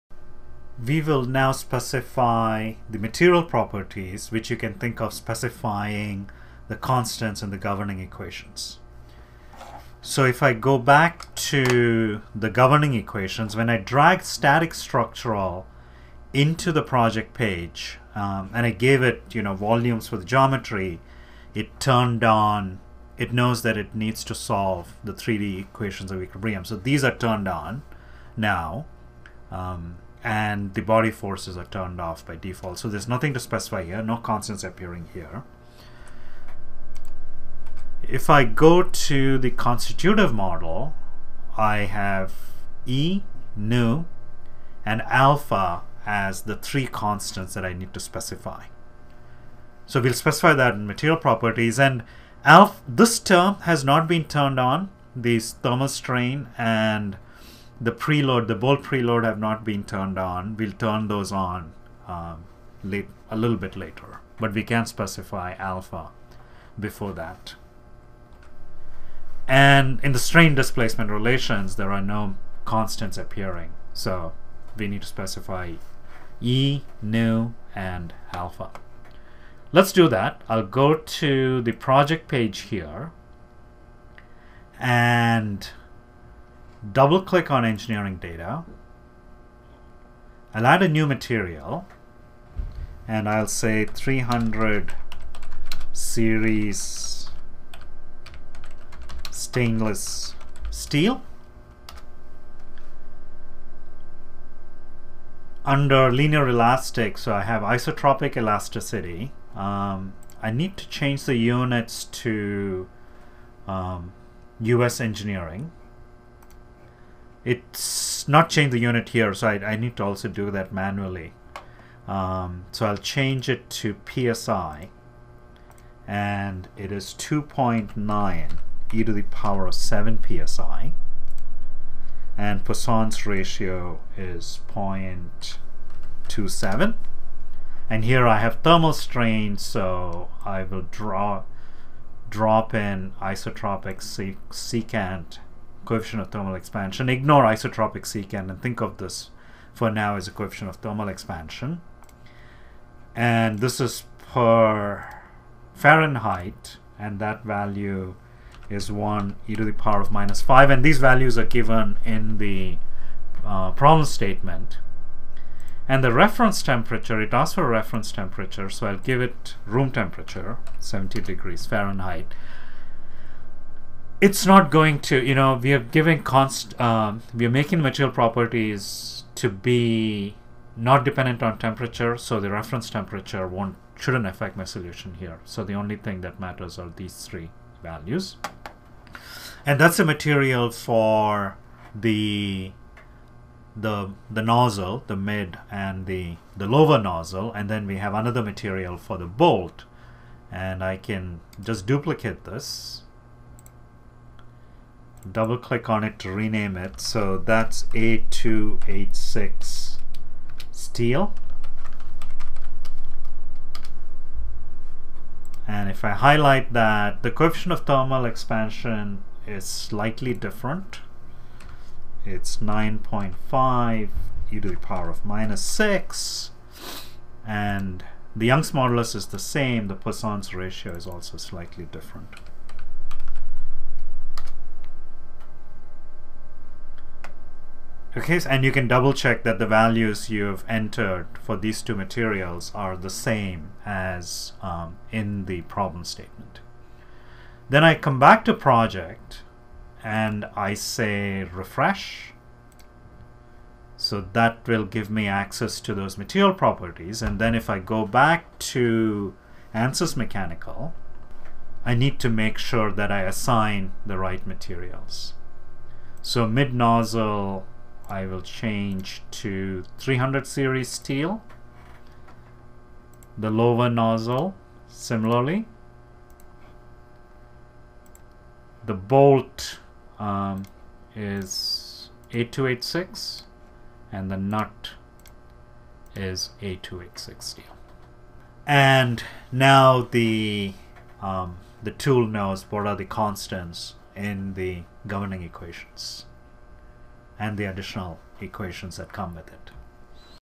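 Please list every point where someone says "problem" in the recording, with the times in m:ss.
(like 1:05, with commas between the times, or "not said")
2:43, 4:05.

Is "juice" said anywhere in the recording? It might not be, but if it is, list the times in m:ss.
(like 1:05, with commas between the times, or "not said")
not said.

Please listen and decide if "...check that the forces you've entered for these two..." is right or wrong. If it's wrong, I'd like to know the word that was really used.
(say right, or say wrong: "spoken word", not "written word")
wrong: "values", not "forces".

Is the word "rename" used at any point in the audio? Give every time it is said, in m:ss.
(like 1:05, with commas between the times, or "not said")
3:26.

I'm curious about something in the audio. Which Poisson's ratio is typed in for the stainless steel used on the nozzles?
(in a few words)
0.27.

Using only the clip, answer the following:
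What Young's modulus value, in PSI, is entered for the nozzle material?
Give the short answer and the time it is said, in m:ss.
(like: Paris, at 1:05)
2.9e7 PSI, at 2:07.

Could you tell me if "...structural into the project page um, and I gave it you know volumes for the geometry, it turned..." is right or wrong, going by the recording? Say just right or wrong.
right.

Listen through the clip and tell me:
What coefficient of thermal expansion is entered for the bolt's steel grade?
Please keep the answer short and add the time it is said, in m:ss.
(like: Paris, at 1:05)
9.5e-6, at 3:42.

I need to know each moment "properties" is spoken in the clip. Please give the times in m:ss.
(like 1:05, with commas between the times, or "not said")
0:03, 0:51, 2:58, 4:16.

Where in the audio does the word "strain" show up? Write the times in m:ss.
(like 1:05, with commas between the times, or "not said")
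0:55, 1:10, 2:18.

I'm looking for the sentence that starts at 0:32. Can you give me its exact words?
So there's nothing to specify here, no constants appearing here.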